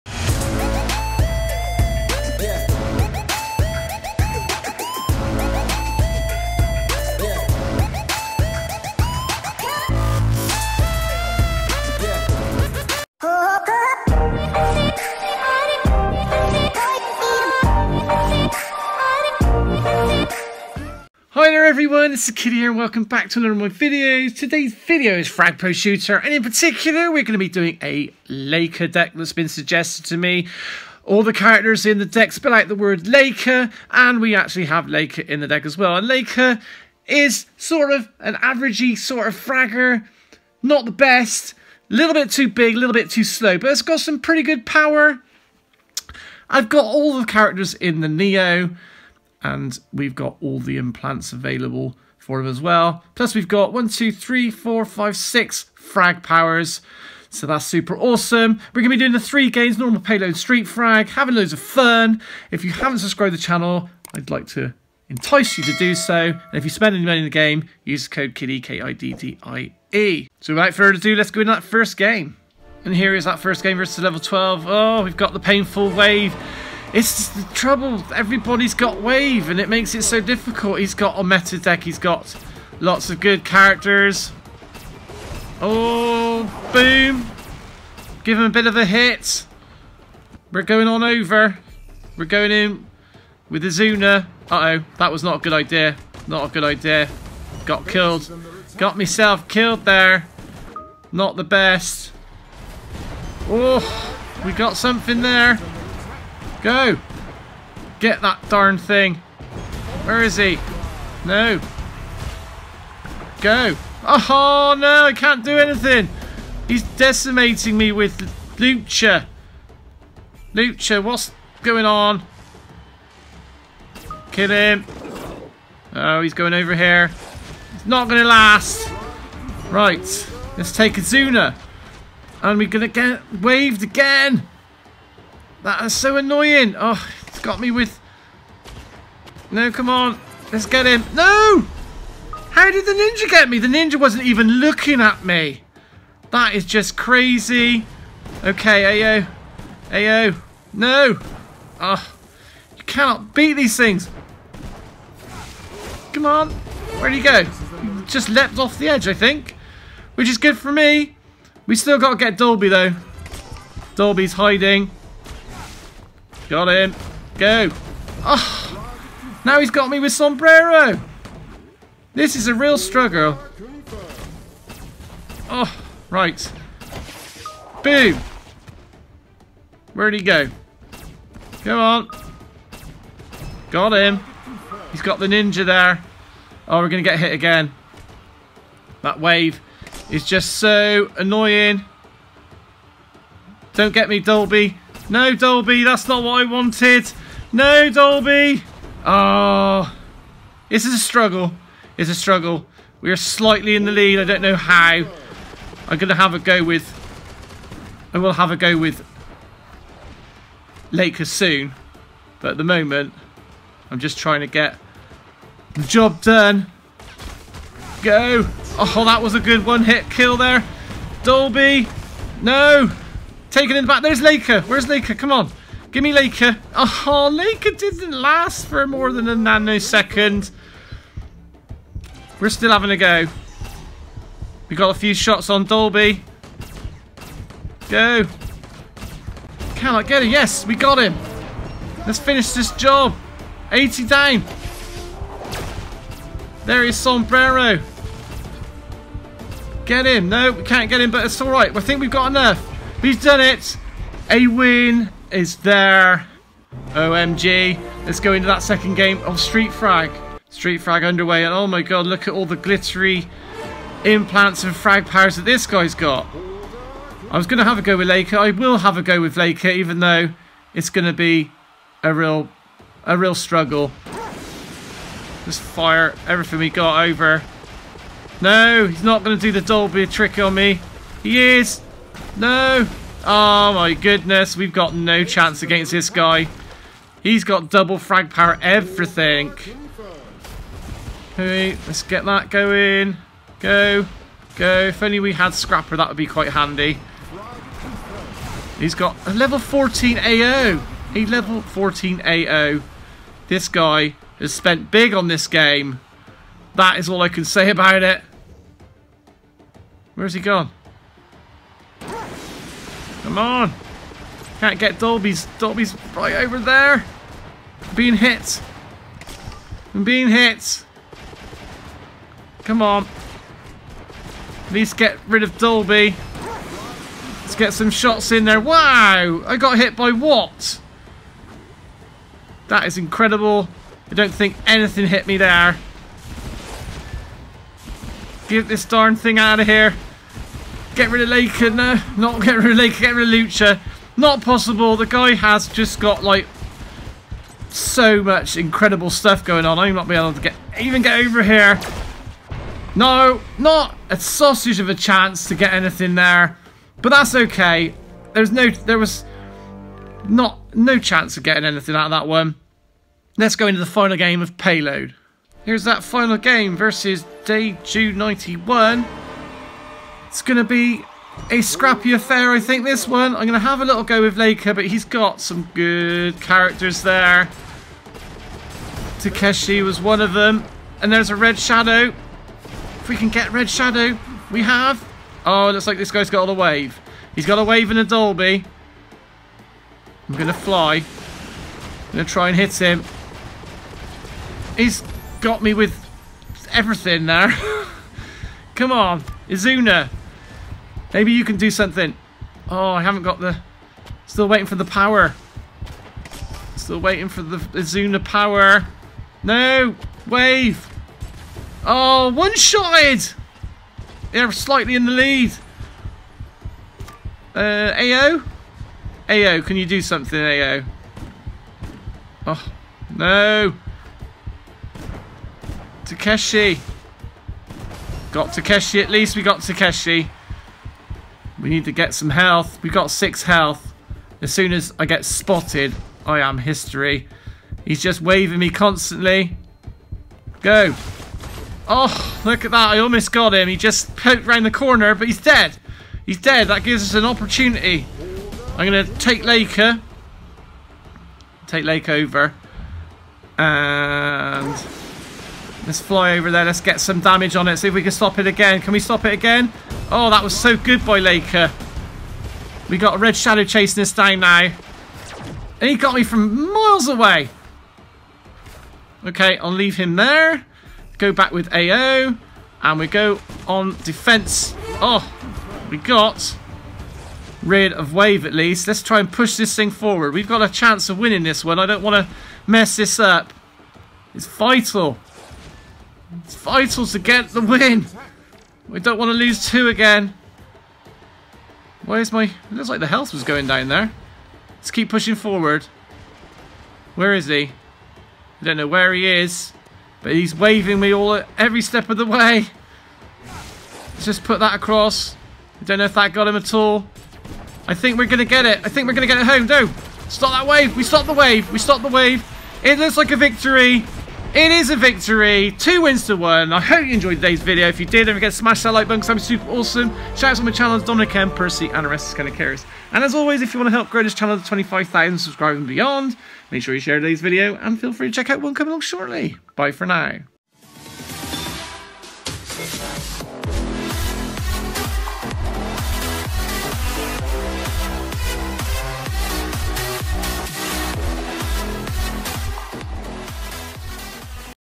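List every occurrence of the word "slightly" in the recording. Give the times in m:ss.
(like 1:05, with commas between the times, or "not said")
3:23, 6:54.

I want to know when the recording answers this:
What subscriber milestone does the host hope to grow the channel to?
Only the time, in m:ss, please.
8:44.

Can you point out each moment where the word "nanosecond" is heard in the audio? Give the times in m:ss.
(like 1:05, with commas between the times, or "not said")
3:49.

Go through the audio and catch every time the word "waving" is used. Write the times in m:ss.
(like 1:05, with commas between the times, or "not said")
7:18, 8:20.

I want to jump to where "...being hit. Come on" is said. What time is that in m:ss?
5:20.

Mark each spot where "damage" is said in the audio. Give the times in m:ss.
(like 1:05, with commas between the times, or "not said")
7:37.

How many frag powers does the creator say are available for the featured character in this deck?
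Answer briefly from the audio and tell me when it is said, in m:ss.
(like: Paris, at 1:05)
6, at 0:53.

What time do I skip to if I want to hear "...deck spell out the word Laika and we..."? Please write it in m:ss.
0:32.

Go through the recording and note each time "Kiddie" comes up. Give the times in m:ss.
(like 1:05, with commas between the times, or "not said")
0:22, 1:08.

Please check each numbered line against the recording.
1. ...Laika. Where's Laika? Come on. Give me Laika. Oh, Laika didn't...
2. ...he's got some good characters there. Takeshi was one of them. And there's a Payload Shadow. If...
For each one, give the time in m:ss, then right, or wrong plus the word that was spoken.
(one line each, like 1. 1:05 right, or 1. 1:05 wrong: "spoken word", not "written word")
1. 3:44 right
2. 6:14 wrong: "Red", not "Payload".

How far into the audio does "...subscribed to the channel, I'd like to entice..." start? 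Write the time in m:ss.
1:02.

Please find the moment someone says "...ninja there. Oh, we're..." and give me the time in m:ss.
3:05.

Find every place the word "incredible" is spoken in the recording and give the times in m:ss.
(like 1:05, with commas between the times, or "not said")
5:32, 5:48.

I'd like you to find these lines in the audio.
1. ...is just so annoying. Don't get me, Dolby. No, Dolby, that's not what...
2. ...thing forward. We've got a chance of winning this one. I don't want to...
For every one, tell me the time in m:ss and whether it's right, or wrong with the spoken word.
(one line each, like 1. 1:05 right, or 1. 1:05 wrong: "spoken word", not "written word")
1. 3:10 right
2. 7:59 right.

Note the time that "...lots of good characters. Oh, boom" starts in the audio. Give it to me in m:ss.
1:22.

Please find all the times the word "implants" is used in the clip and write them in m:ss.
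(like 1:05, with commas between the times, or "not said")
0:50, 4:24.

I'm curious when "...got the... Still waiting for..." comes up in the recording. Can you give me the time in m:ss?
6:43.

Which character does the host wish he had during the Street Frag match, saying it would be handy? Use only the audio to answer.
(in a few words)
Scrapper.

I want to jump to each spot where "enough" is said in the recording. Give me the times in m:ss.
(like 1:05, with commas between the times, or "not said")
4:12.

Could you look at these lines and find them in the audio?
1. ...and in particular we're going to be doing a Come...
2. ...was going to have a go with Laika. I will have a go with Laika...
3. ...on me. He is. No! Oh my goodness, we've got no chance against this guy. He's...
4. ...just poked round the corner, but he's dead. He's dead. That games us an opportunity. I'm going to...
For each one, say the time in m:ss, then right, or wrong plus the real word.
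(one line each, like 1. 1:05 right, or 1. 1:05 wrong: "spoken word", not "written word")
1. 0:26 wrong: "Laika", not "Come"
2. 4:27 right
3. 4:40 right
4. 7:23 wrong: "gives", not "games".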